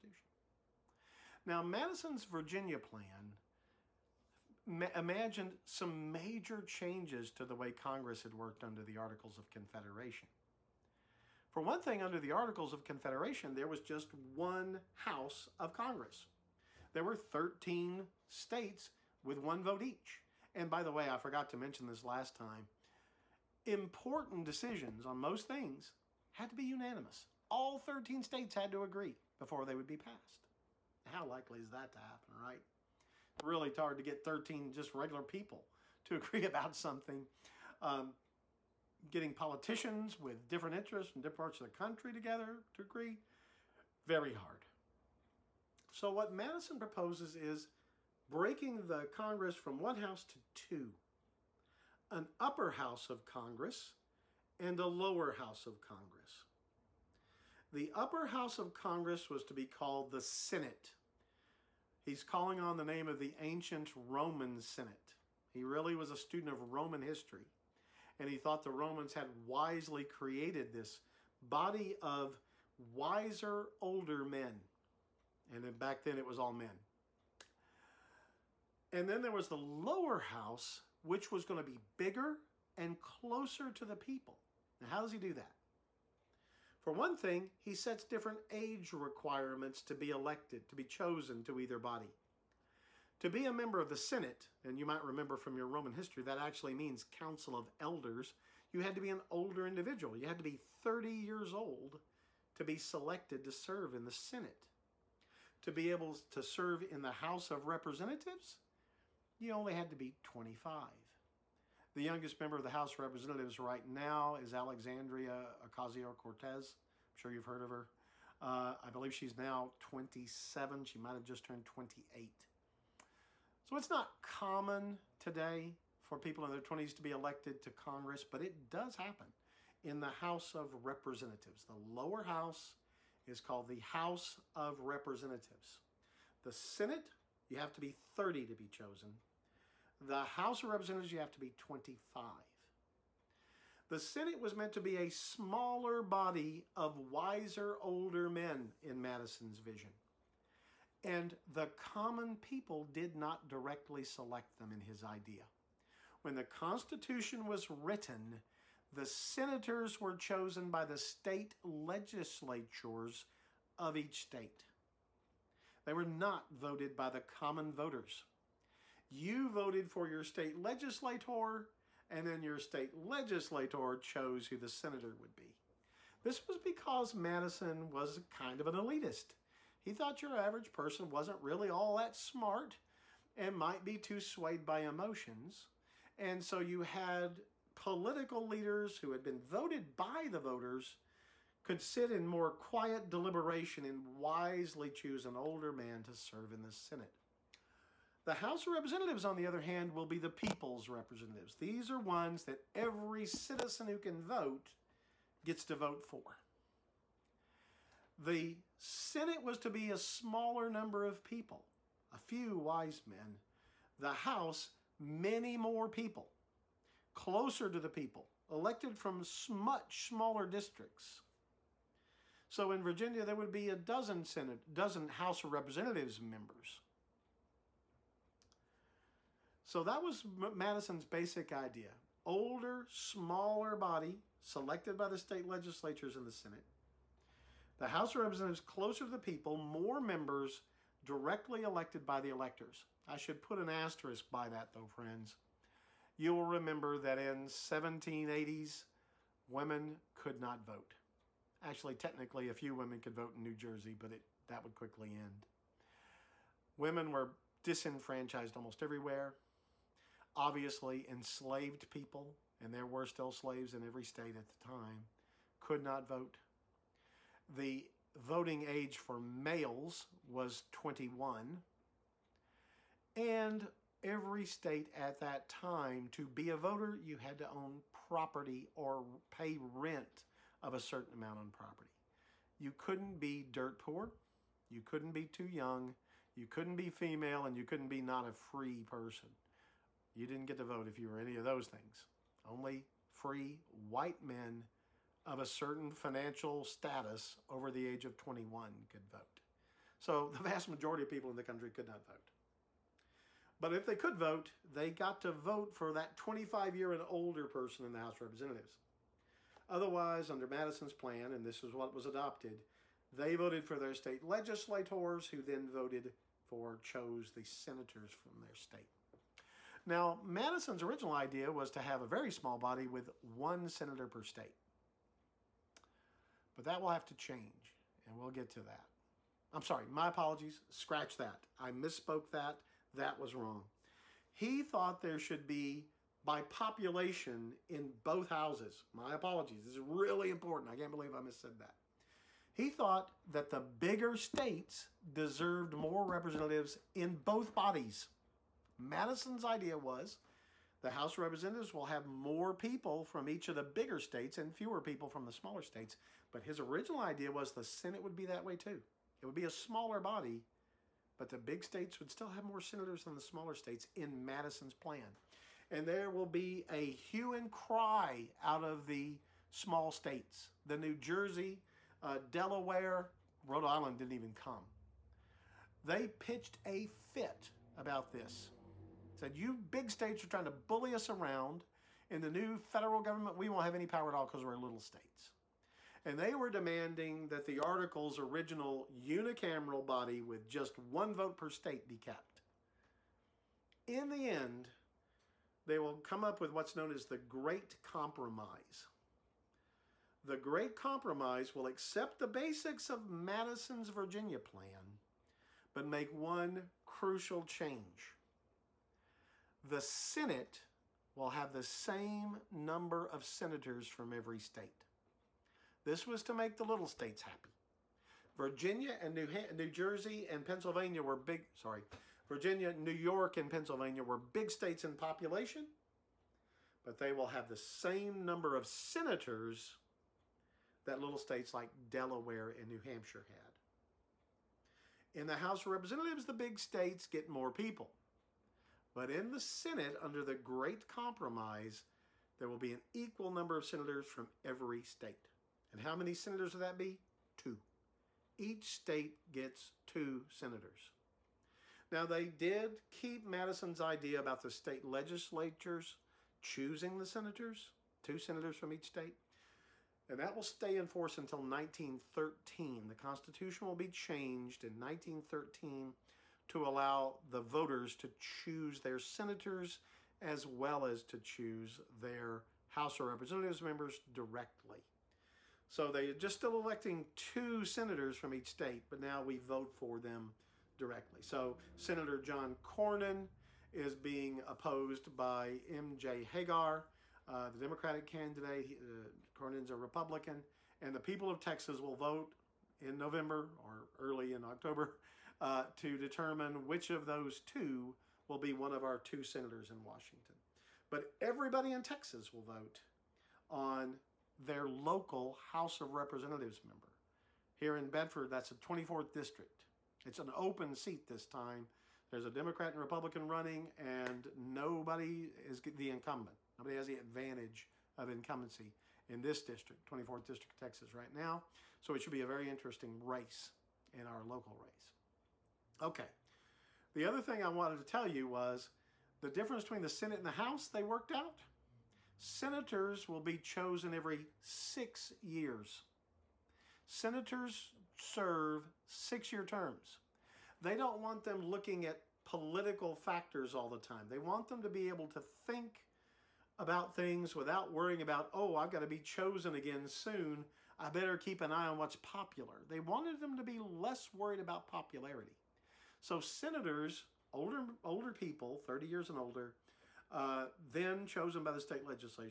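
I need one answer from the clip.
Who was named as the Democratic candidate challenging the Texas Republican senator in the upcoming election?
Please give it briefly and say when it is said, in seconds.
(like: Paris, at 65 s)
M.J. Hegar, at 485 s.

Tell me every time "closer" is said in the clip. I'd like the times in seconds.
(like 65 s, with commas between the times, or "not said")
82 s, 217 s, 238 s.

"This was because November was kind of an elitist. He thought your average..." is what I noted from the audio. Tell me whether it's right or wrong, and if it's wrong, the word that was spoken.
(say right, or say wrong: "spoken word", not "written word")
wrong: "Madison", not "November".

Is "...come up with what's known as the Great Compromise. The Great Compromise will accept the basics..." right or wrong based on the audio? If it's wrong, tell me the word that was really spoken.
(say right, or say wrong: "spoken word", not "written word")
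right.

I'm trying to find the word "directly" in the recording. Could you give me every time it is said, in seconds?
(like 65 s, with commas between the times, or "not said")
153 s, 241 s, 473 s, 480 s.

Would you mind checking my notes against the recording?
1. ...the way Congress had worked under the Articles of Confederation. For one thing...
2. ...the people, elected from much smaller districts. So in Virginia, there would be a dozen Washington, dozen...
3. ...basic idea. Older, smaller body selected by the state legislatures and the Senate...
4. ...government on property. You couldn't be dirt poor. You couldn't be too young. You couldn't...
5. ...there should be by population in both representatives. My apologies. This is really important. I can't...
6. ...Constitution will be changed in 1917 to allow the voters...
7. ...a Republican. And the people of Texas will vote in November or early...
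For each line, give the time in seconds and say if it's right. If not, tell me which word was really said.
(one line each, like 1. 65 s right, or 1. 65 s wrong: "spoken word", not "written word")
1. 7 s right
2. 217 s wrong: "Senate", not "Washington"
3. 231 s right
4. 281 s wrong: "amount", not "government"
5. 335 s wrong: "houses", not "representatives"
6. 462 s wrong: "1913", not "1917"
7. 489 s right.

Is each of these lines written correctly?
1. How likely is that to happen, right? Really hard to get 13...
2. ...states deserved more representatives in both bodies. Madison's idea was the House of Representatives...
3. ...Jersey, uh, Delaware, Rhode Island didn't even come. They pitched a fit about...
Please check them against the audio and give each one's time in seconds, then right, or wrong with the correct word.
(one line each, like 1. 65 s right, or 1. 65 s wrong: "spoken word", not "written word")
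1. 31 s right
2. 344 s right
3. 370 s right.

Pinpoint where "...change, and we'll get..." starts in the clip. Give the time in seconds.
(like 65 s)
327 s.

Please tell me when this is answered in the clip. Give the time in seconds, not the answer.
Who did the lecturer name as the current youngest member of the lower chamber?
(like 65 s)
114 s.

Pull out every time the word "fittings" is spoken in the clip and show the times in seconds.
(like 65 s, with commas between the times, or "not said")
not said.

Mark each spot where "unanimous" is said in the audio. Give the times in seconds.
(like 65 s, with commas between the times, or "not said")
26 s.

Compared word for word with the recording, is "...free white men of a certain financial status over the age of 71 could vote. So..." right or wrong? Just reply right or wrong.
wrong.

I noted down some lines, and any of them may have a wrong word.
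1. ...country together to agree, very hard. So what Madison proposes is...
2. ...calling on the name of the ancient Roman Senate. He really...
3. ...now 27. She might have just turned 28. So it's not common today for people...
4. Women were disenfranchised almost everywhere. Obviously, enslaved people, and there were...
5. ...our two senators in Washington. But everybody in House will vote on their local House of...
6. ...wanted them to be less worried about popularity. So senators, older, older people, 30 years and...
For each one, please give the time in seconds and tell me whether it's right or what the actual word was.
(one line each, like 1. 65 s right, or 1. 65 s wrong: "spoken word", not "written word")
1. 41 s right
2. 62 s right
3. 119 s right
4. 256 s right
5. 498 s wrong: "Texas", not "House"
6. 552 s right.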